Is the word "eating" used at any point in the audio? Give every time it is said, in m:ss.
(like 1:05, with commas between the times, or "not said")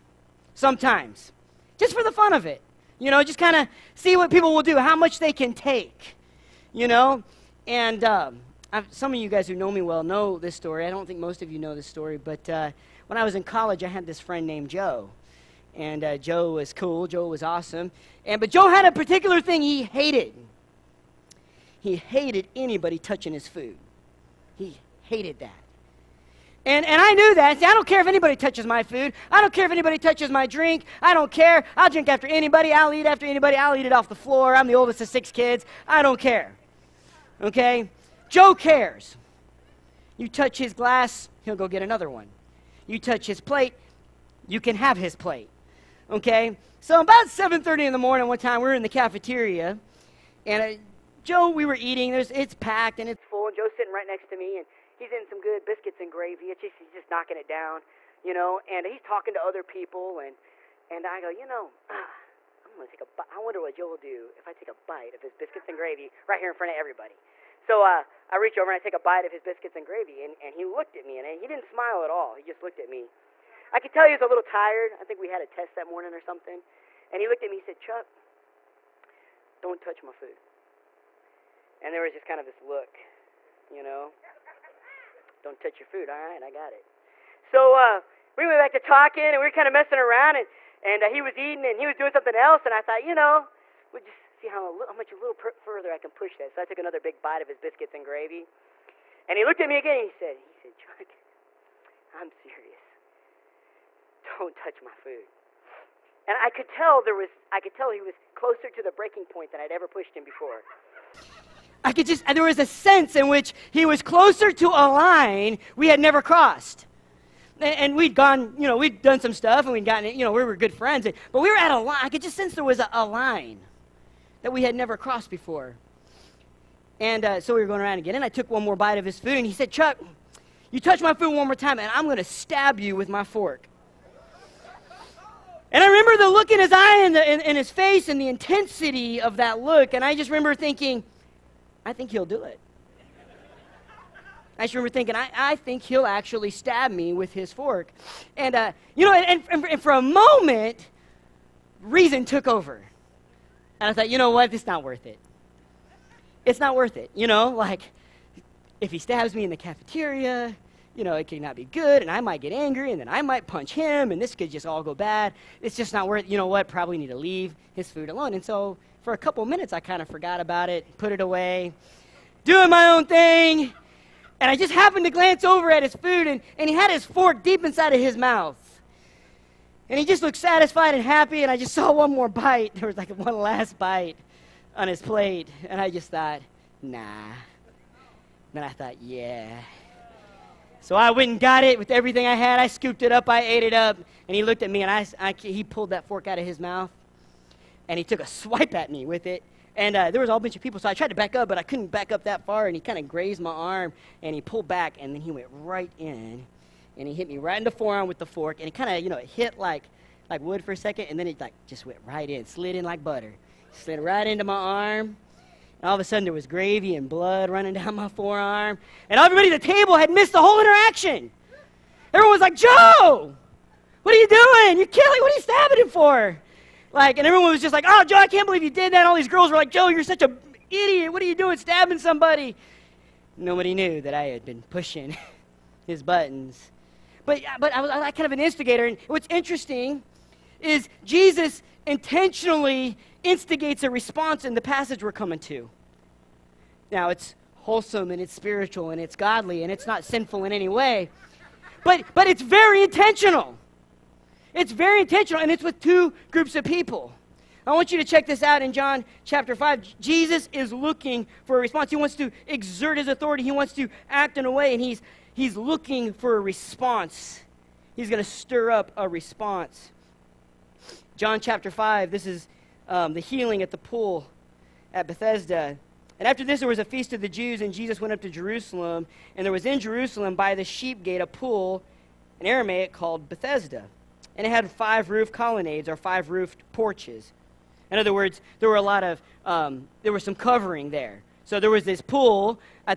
0:51, 1:31.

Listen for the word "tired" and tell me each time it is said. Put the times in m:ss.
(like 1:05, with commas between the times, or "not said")
1:14.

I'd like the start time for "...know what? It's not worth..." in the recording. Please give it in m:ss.
2:34.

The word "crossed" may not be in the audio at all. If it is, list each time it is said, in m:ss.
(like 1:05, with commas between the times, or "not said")
1:56, 2:04.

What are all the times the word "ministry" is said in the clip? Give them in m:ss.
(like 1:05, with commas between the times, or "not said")
not said.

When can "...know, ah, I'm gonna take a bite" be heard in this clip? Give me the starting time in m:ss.
1:01.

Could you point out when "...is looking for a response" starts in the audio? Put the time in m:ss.
4:20.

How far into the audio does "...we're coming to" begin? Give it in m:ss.
4:05.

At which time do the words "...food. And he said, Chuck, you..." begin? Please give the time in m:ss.
2:09.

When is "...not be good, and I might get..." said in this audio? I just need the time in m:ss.
2:41.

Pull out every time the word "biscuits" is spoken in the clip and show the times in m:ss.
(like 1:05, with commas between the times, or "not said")
0:55, 1:05, 1:09, 1:37.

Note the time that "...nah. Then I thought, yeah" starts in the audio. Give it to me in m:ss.
3:06.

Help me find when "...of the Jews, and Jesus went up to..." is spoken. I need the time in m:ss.
4:37.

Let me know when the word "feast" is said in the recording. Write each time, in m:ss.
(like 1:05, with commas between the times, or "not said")
4:36.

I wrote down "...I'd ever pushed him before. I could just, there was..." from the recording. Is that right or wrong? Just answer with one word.
right.